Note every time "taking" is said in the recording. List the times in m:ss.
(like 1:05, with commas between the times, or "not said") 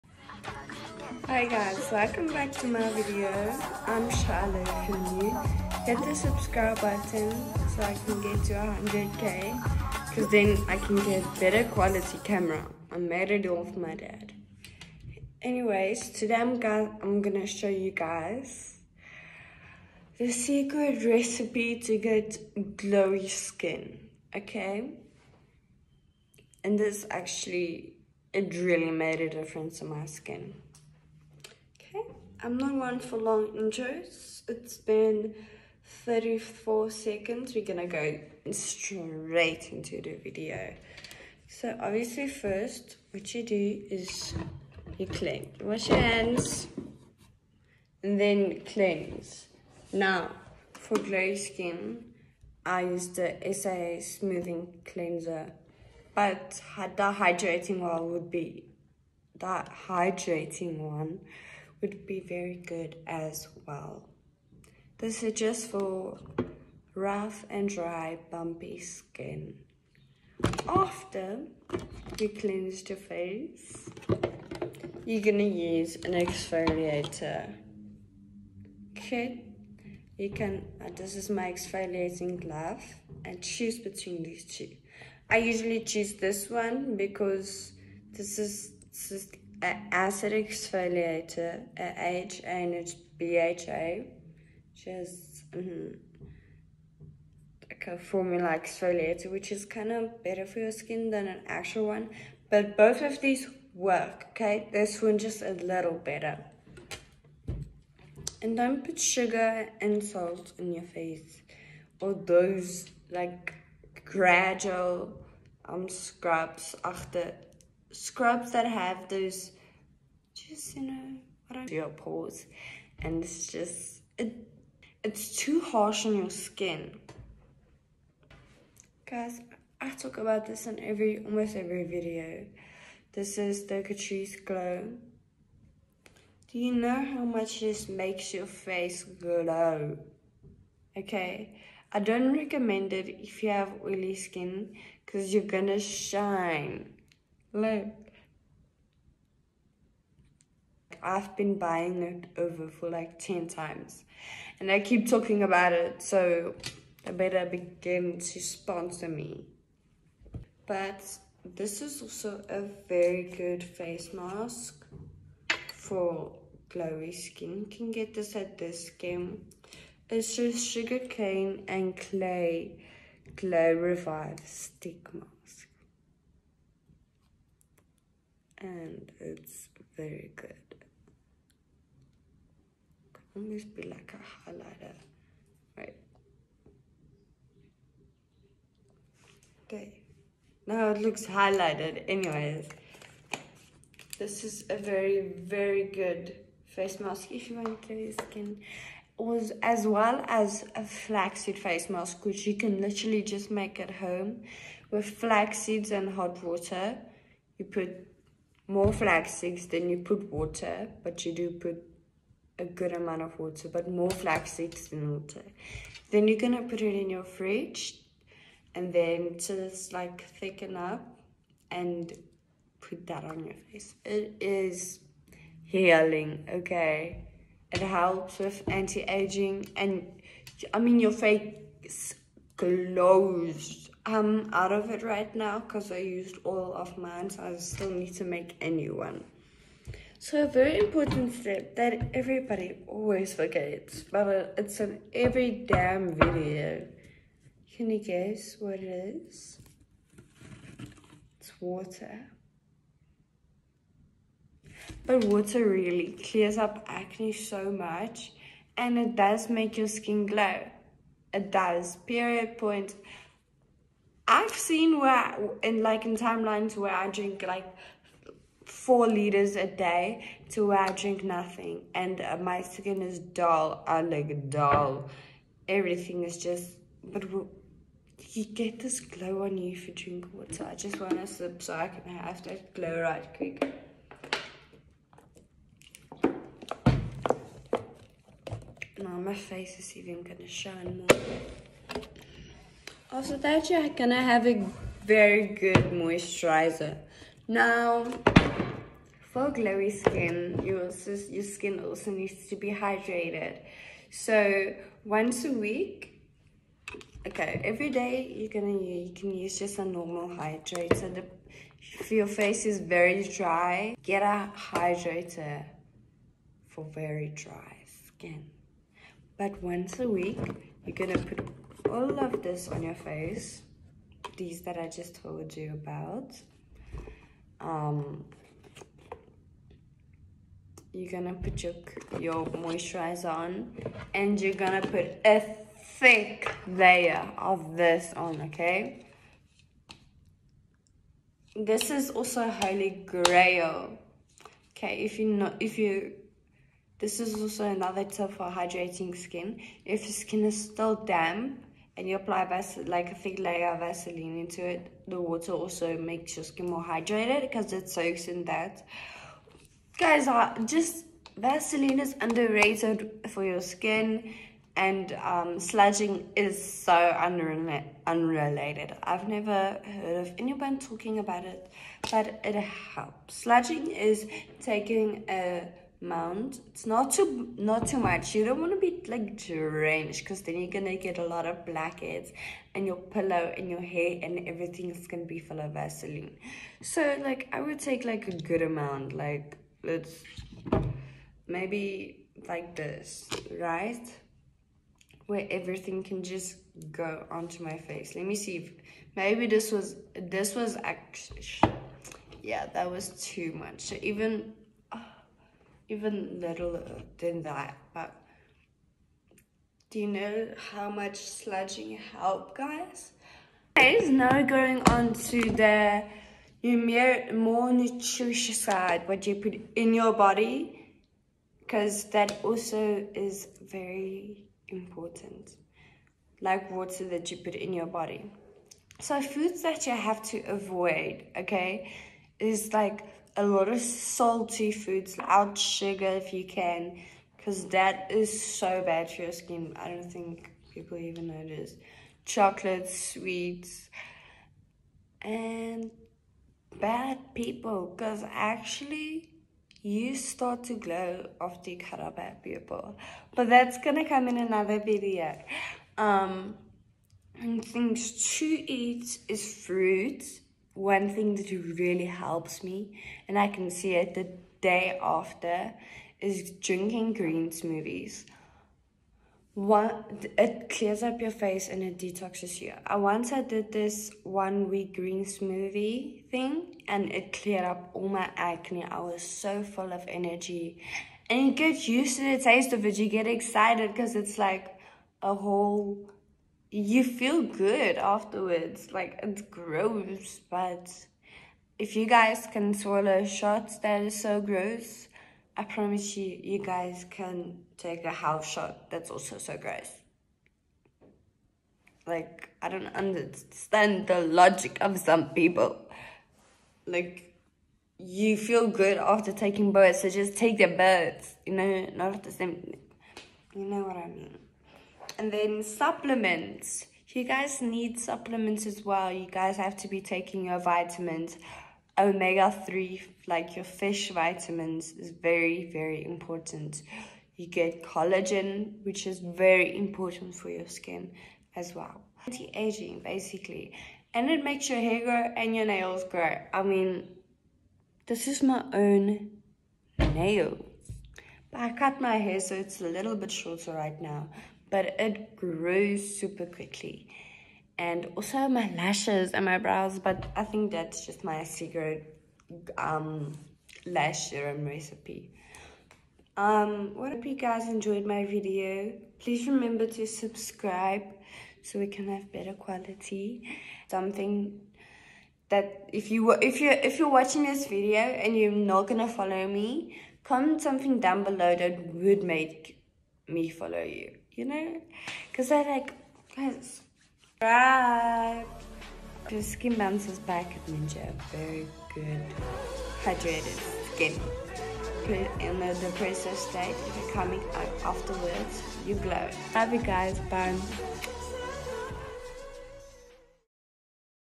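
6:14, 8:29, 8:40.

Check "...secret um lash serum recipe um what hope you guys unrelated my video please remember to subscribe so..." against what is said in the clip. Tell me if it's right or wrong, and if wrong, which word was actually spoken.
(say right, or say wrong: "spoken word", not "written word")
wrong: "enjoyed", not "unrelated".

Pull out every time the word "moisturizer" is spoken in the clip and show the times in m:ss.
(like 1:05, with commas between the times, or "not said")
4:55, 5:32.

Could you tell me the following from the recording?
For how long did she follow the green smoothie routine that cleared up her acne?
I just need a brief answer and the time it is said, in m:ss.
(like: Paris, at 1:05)
one week, at 7:54.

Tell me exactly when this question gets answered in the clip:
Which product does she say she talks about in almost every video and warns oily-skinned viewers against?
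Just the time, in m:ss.
2:13.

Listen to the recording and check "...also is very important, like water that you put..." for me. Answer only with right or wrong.
right.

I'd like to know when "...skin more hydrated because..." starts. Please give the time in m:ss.
5:56.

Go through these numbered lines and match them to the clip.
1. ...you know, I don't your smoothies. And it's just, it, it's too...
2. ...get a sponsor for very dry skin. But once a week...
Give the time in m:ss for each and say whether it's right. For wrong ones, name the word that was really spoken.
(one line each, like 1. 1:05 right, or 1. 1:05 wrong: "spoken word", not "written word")
1. 2:00 wrong: "pores", not "smoothies"
2. 5:14 wrong: "hydrator", not "sponsor".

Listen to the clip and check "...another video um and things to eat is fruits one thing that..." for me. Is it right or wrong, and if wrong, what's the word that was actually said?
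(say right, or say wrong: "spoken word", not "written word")
right.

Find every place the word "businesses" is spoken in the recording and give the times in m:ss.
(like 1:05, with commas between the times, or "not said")
not said.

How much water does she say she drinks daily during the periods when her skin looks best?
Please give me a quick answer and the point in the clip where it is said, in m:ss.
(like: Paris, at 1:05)
4 liters, at 4:28.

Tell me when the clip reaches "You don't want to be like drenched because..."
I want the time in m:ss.
6:18.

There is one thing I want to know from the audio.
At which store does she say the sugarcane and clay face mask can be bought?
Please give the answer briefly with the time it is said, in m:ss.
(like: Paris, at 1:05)
Dis-Chem, at 2:48.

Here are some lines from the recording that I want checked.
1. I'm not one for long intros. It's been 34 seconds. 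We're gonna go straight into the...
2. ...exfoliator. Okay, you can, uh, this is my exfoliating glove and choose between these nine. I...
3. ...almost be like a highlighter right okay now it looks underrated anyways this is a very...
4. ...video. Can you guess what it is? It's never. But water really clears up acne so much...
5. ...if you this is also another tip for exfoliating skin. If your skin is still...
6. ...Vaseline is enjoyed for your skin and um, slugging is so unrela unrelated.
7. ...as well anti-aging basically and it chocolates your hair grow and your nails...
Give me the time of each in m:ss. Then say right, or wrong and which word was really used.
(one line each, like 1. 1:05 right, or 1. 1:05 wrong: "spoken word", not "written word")
1. 0:32 right
2. 1:16 wrong: "two", not "nine"
3. 3:03 wrong: "highlighted", not "underrated"
4. 4:06 wrong: "water", not "never"
5. 5:45 wrong: "hydrating", not "exfoliating"
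6. 6:01 wrong: "underrated", not "enjoyed"
7. 8:51 wrong: "makes", not "chocolates".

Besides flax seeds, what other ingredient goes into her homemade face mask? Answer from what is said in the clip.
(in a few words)
hot water.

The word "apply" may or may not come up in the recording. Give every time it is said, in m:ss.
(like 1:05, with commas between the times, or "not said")
5:52.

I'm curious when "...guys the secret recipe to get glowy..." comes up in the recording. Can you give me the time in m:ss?
0:17.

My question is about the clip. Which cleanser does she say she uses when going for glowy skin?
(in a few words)
SAA Smoothing Cleanser.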